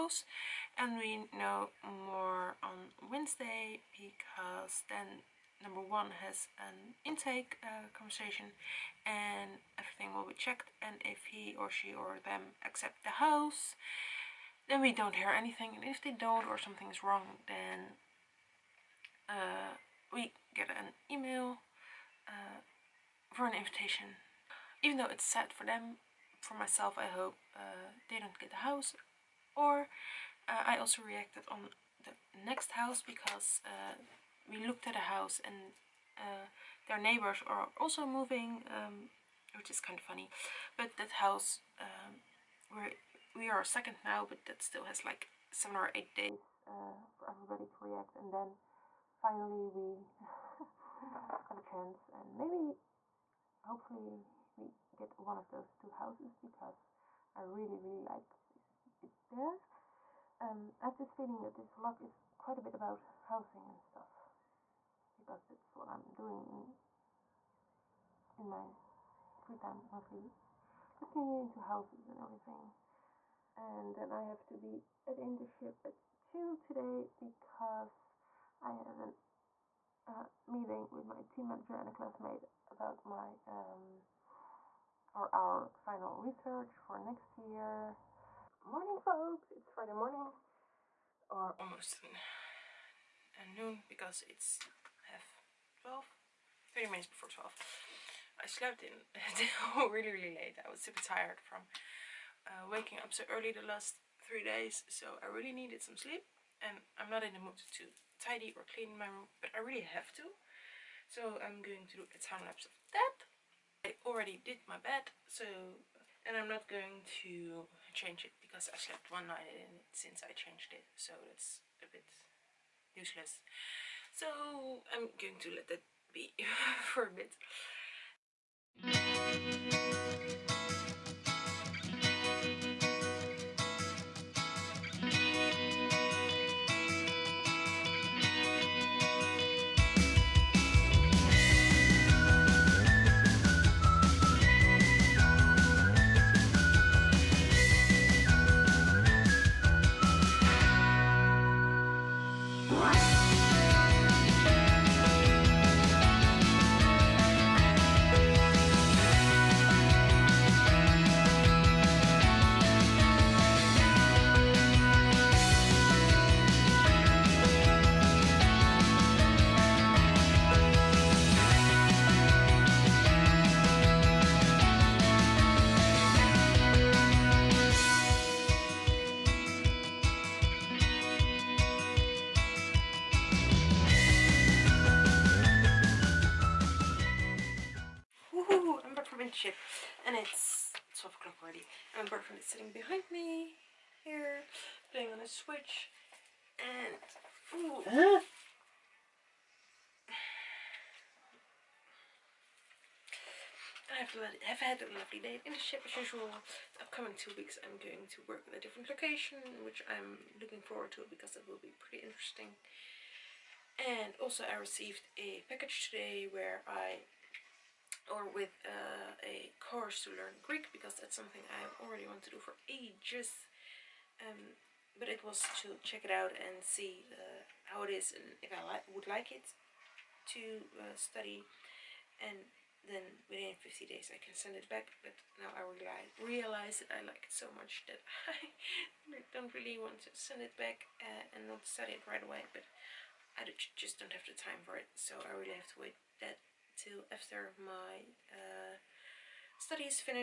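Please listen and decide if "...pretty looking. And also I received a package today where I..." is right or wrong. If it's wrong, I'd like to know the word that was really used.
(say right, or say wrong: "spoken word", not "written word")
wrong: "interesting", not "looking".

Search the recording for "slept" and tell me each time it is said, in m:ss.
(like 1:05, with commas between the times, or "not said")
1:38, 1:58.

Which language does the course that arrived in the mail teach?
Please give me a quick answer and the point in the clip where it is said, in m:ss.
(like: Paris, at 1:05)
Greek, at 3:40.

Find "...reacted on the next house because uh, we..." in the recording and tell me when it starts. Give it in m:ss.
0:31.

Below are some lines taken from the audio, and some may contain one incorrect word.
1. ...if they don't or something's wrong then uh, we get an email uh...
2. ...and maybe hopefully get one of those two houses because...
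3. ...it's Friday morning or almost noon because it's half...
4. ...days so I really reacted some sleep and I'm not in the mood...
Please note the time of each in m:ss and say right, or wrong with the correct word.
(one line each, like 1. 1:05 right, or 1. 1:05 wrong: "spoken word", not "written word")
1. 0:15 right
2. 0:52 right
3. 1:29 right
4. 1:44 wrong: "needed", not "reacted".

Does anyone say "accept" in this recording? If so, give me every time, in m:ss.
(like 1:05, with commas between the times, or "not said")
0:12.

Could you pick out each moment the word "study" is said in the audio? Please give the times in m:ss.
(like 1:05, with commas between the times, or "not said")
3:50, 4:01, 4:09.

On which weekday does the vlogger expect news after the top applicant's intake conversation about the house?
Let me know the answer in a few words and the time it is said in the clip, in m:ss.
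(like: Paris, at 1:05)
Wednesday, at 0:03.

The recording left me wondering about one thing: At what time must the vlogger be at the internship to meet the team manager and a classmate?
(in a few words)
2.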